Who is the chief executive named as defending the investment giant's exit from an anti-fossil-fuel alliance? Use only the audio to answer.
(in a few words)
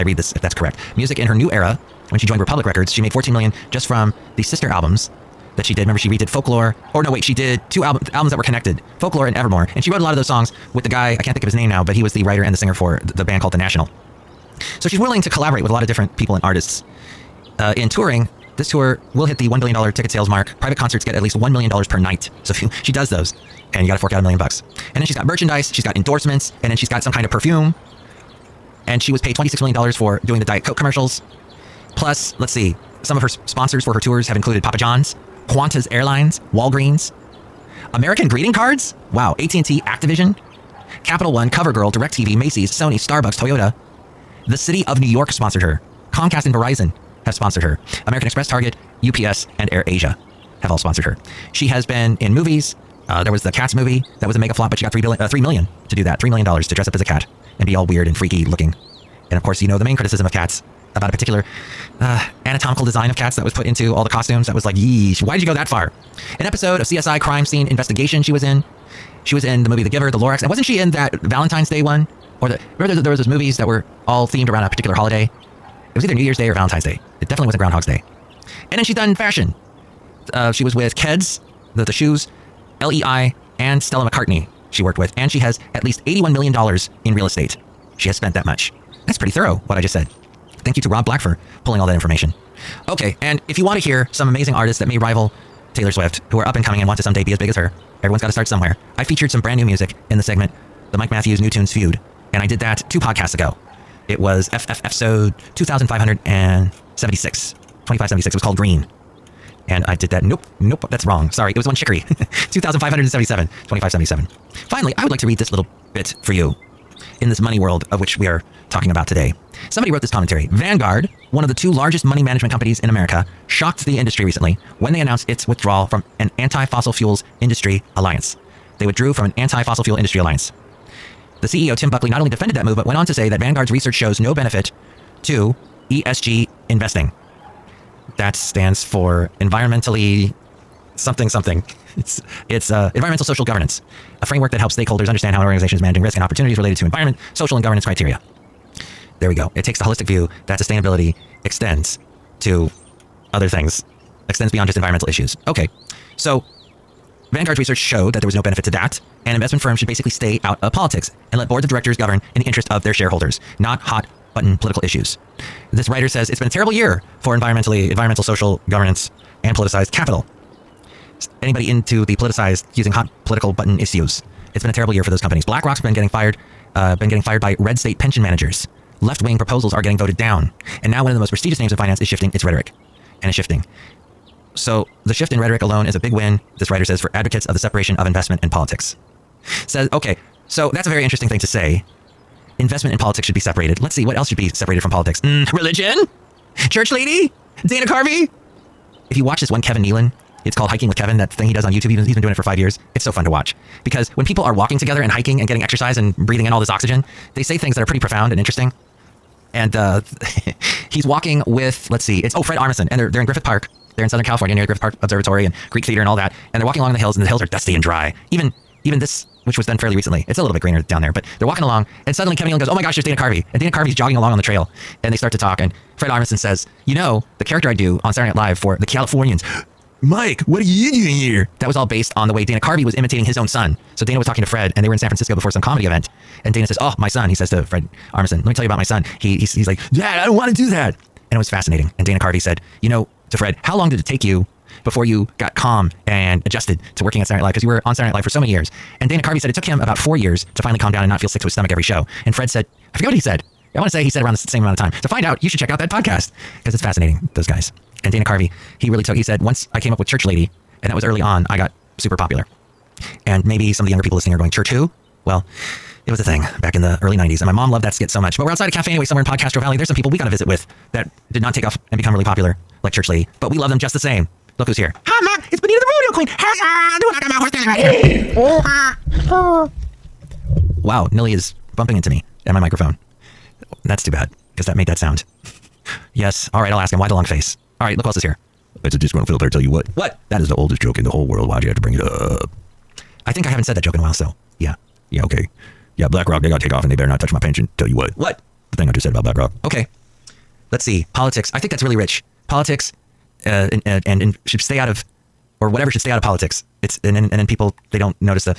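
Tim Buckley.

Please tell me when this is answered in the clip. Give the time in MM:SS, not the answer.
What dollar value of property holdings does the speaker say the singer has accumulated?
01:26.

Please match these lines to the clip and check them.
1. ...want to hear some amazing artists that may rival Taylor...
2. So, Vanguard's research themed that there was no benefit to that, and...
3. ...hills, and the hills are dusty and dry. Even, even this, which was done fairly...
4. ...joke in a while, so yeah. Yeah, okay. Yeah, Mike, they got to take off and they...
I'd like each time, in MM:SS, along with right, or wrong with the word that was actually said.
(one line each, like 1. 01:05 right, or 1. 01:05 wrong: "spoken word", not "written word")
1. 01:33 right
2. 02:36 wrong: "showed", not "themed"
3. 03:36 right
4. 04:53 wrong: "BlackRock", not "Mike".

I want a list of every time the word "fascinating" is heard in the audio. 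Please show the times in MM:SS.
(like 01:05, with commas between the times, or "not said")
04:01, 04:16.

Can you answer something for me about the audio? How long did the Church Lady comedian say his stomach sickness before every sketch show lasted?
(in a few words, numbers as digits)
4 years.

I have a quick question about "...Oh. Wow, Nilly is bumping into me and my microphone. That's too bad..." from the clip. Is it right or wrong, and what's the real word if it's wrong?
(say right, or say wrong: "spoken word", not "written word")
right.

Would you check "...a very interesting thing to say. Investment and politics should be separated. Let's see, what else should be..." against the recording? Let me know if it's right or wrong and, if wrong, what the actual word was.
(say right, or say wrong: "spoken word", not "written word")
right.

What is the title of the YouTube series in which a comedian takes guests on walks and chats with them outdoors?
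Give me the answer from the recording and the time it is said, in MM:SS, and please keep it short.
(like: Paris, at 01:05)
Hiking with Kevin, at 03:20.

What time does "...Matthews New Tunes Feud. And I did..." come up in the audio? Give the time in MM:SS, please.
01:41.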